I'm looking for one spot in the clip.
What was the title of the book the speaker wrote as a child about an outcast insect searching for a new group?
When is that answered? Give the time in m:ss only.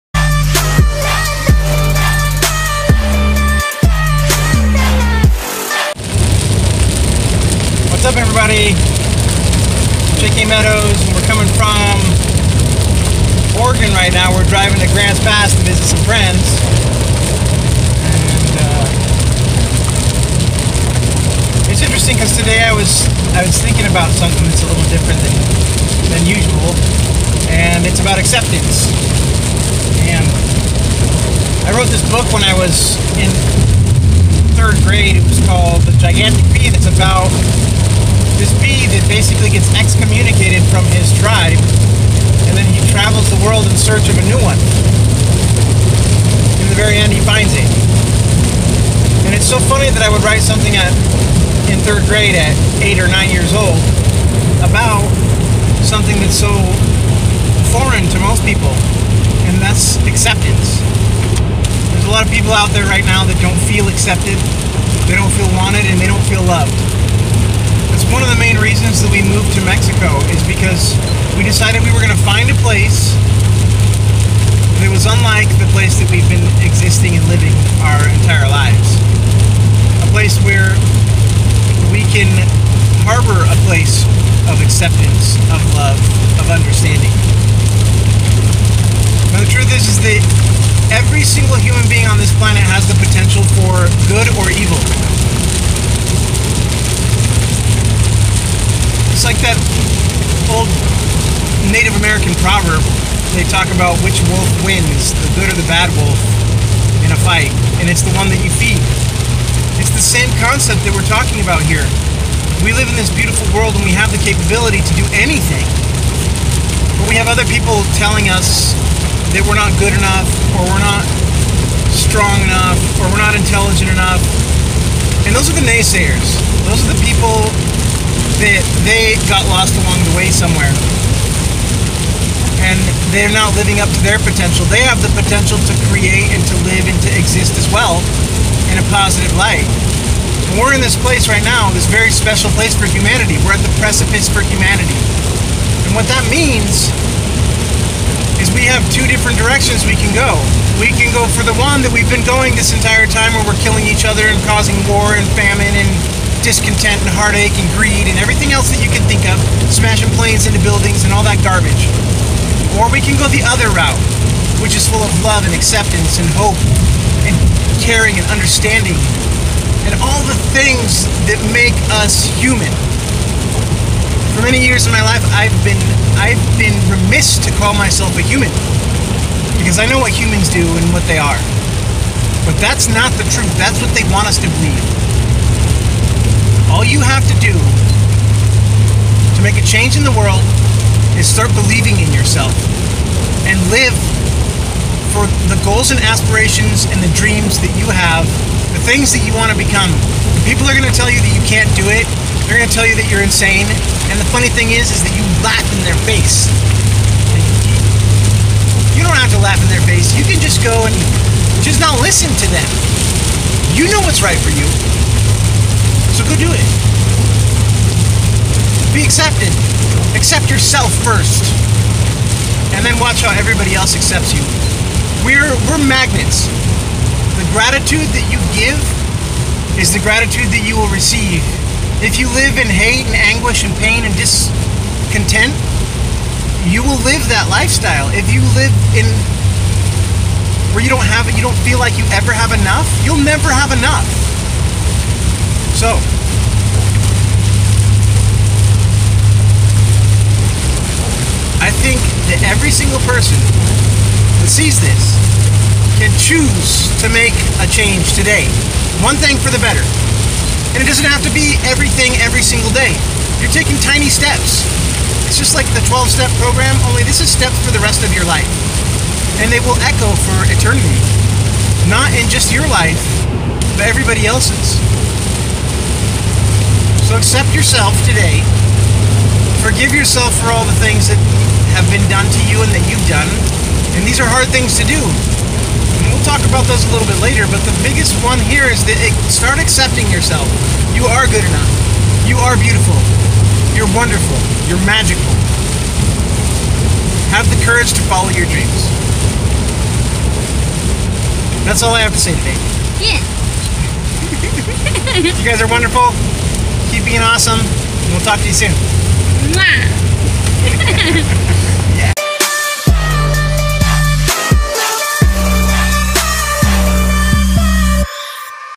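0:35.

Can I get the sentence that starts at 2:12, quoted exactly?
And they're not living up to their potential.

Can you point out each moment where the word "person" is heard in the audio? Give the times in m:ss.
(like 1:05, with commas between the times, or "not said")
4:13.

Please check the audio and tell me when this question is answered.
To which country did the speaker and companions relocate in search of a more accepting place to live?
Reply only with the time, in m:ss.
1:09.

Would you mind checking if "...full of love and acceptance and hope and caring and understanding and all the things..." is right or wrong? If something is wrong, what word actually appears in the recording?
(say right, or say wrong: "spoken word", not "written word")
right.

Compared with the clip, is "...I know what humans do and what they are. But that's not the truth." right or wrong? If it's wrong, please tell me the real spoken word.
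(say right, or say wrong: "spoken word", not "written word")
right.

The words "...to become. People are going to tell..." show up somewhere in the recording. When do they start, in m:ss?
3:19.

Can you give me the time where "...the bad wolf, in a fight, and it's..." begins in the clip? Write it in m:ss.
1:45.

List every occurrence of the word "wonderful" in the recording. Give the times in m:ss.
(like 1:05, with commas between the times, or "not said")
4:53, 5:05.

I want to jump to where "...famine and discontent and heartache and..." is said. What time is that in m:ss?
2:35.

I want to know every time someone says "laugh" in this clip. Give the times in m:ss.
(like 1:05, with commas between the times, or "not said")
3:25, 3:29.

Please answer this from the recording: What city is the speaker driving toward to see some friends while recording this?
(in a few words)
Grants Pass.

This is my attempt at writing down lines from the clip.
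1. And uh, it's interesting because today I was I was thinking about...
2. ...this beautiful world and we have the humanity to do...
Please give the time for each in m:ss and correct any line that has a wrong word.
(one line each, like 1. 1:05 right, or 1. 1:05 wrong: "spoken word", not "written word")
1. 0:18 right
2. 1:52 wrong: "capability", not "humanity".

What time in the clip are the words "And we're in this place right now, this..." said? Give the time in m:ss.
2:20.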